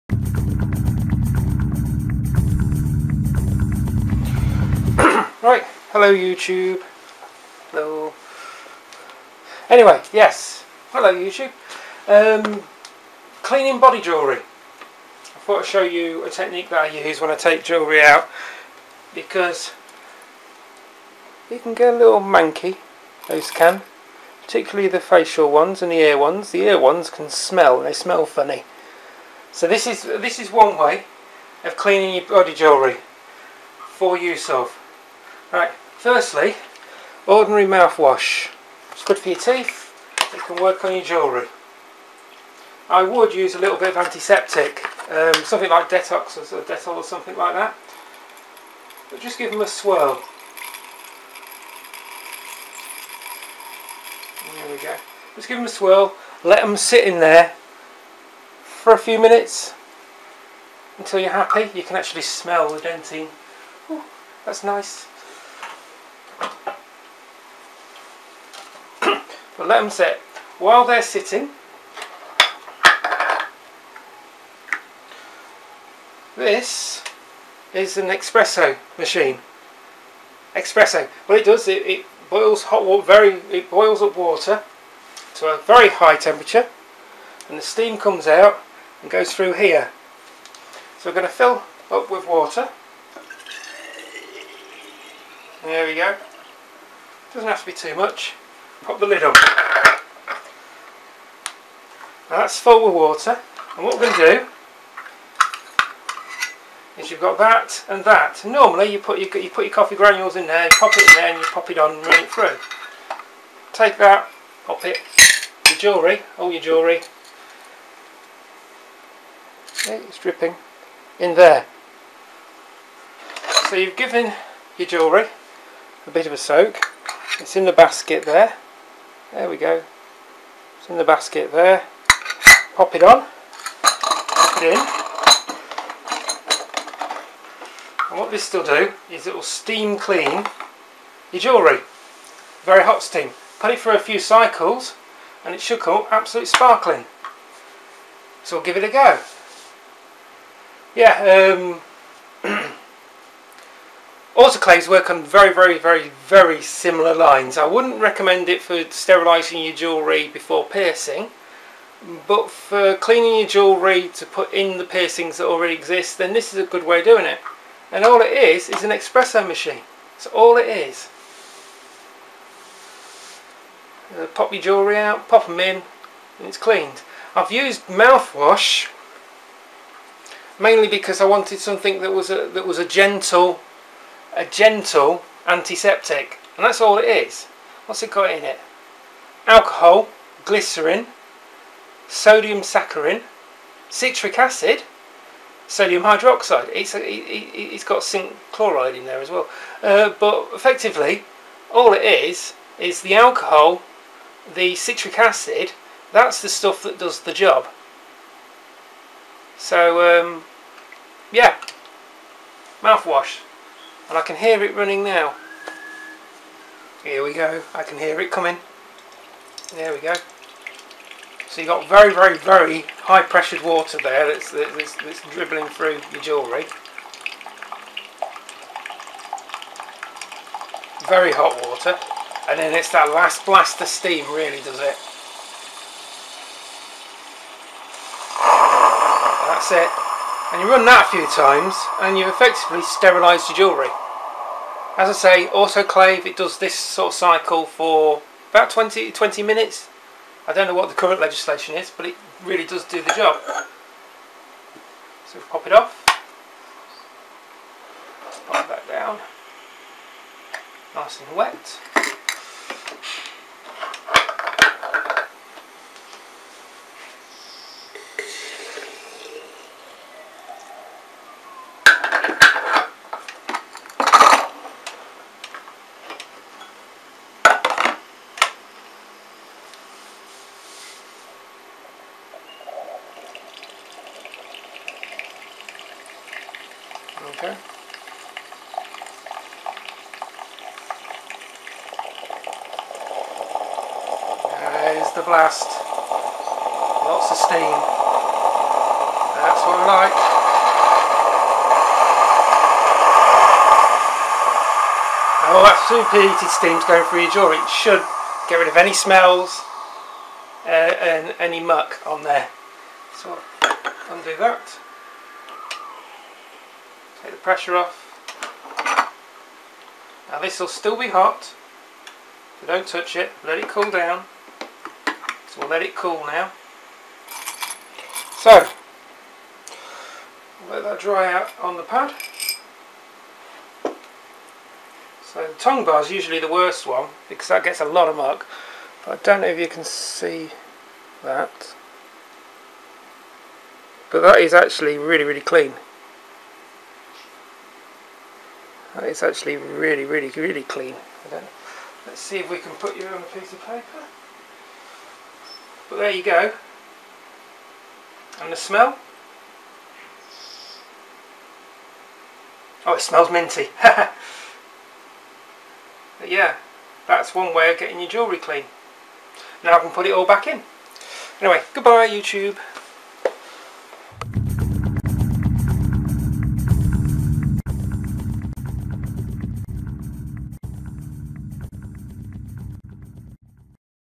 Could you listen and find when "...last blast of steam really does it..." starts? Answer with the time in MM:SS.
03:53.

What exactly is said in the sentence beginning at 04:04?
As I say, autoclave, it does this sort of cycle for about 20, 20 minutes.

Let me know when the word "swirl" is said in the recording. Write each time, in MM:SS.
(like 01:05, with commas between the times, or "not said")
00:49, 00:55.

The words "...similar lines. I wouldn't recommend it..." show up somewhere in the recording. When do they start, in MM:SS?
02:36.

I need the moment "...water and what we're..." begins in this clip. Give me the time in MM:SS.
01:42.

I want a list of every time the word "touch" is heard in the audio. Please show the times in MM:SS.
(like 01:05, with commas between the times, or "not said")
05:22.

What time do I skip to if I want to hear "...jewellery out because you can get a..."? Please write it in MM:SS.
00:17.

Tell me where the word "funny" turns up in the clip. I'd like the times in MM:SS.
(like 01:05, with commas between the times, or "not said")
00:28.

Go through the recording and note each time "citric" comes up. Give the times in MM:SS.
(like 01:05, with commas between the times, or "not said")
03:13, 03:24.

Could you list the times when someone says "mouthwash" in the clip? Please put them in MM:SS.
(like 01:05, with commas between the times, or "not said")
00:37, 02:57, 03:32.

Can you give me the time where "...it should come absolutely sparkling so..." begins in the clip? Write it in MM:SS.
02:25.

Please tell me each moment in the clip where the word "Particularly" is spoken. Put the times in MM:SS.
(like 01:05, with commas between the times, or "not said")
00:24.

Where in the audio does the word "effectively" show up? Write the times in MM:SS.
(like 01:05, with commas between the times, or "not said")
03:20, 04:02.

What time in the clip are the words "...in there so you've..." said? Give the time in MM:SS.
02:01.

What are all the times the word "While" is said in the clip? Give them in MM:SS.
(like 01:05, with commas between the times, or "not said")
01:10.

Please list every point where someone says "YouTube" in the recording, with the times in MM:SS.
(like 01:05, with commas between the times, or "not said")
00:06, 00:11, 06:12.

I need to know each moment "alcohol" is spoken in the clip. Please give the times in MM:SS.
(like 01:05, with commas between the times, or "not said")
03:09, 03:23.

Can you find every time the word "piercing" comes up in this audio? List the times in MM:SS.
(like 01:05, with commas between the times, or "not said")
02:40, 02:44.